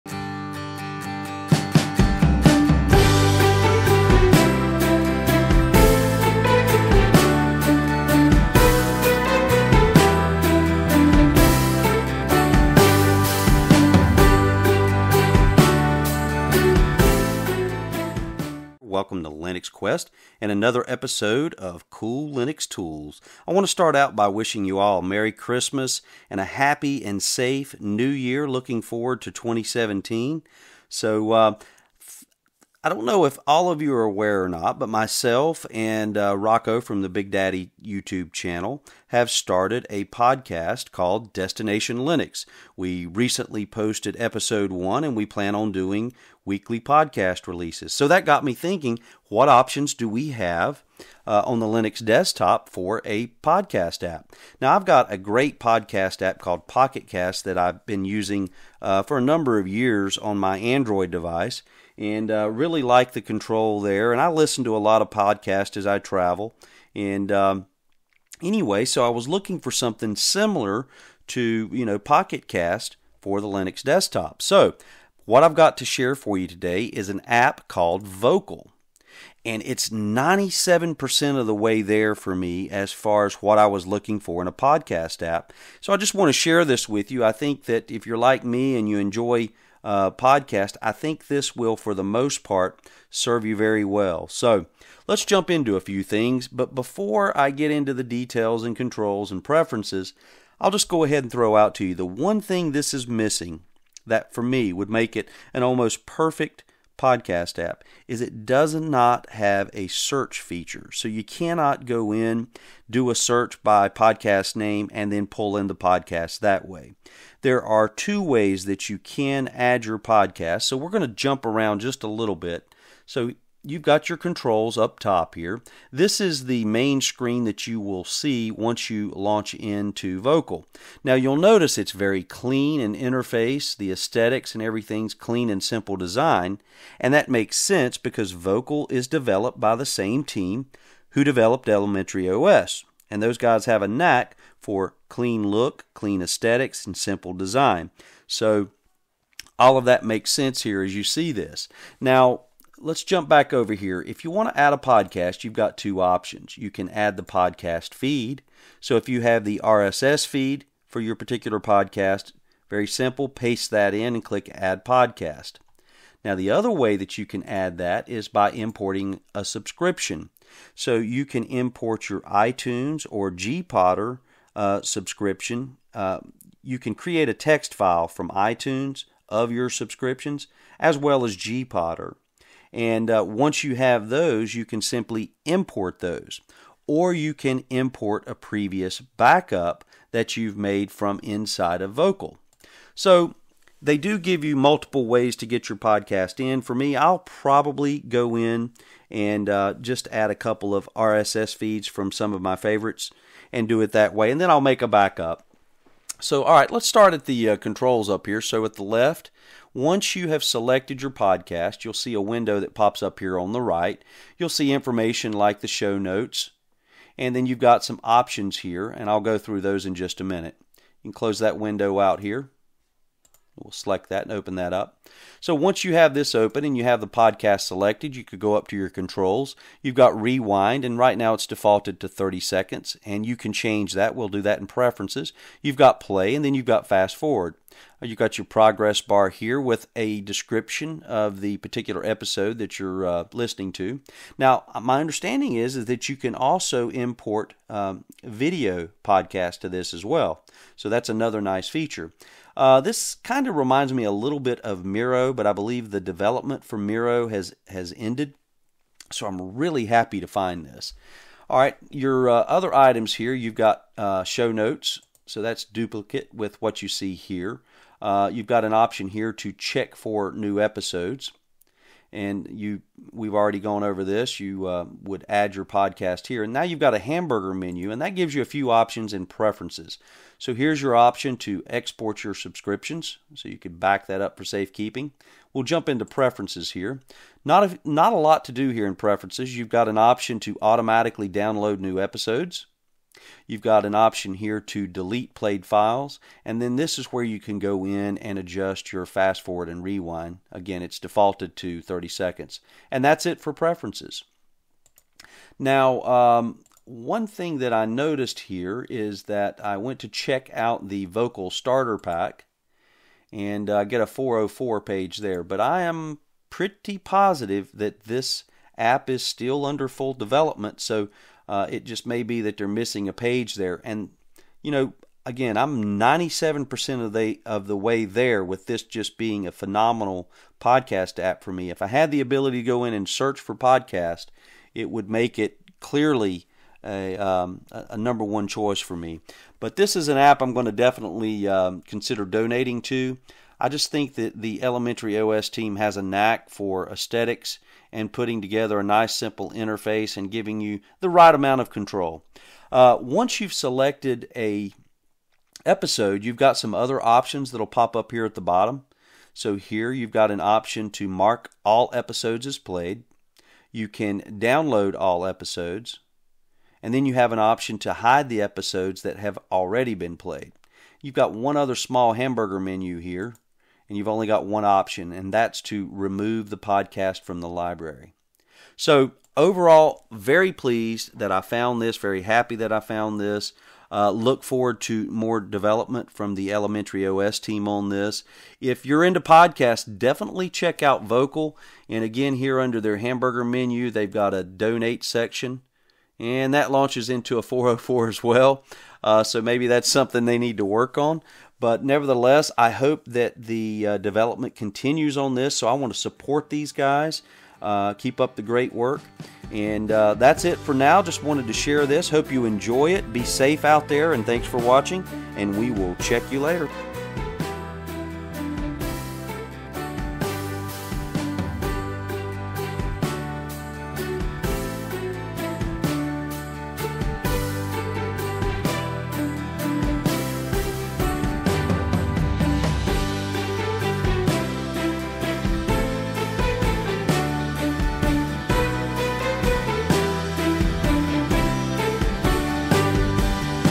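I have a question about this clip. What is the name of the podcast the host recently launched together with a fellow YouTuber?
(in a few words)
Destination Linux.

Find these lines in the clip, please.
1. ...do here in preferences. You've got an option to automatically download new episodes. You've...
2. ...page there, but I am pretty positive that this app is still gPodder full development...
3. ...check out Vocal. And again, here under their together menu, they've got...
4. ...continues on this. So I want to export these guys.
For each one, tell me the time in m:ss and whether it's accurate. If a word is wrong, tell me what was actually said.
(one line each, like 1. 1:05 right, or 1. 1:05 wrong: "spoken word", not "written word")
1. 4:48 right
2. 5:14 wrong: "under", not "gPodder"
3. 6:30 wrong: "hamburger", not "together"
4. 6:44 wrong: "support", not "export".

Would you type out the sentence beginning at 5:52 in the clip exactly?
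Uh, once you've selected a episode, you've got some other options that'll pop up here at the bottom.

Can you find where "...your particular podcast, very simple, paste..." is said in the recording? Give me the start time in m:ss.
2:40.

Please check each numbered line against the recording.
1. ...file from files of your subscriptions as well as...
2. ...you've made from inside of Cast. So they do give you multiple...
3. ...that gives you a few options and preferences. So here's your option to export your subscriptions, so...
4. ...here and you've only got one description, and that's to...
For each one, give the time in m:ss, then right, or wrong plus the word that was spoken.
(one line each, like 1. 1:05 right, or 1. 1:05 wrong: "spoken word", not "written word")
1. 2:57 wrong: "iTunes", not "files"
2. 3:10 wrong: "Vocal", not "Cast"
3. 4:38 right
4. 6:12 wrong: "option", not "description".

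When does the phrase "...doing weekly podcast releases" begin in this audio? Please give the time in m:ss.
0:45.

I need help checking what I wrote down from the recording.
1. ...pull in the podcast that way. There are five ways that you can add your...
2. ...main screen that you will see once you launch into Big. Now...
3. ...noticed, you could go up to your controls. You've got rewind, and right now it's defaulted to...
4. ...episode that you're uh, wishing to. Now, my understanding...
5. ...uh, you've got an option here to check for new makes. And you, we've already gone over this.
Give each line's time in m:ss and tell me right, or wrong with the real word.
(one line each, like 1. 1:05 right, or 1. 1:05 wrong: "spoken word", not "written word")
1. 1:55 wrong: "two", not "five"
2. 2:06 wrong: "Vocal", not "Big"
3. 3:47 wrong: "selected", not "noticed"
4. 4:02 wrong: "listening", not "wishing"
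5. 4:28 wrong: "episodes", not "makes".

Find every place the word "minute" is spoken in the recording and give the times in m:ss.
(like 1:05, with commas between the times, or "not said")
3:40.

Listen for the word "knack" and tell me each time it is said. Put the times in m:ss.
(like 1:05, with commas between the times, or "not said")
2:23, 5:46.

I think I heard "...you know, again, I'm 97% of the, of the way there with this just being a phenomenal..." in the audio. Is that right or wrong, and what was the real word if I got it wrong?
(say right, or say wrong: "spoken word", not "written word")
right.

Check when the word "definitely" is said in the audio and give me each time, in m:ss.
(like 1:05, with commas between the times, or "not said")
5:40, 6:29.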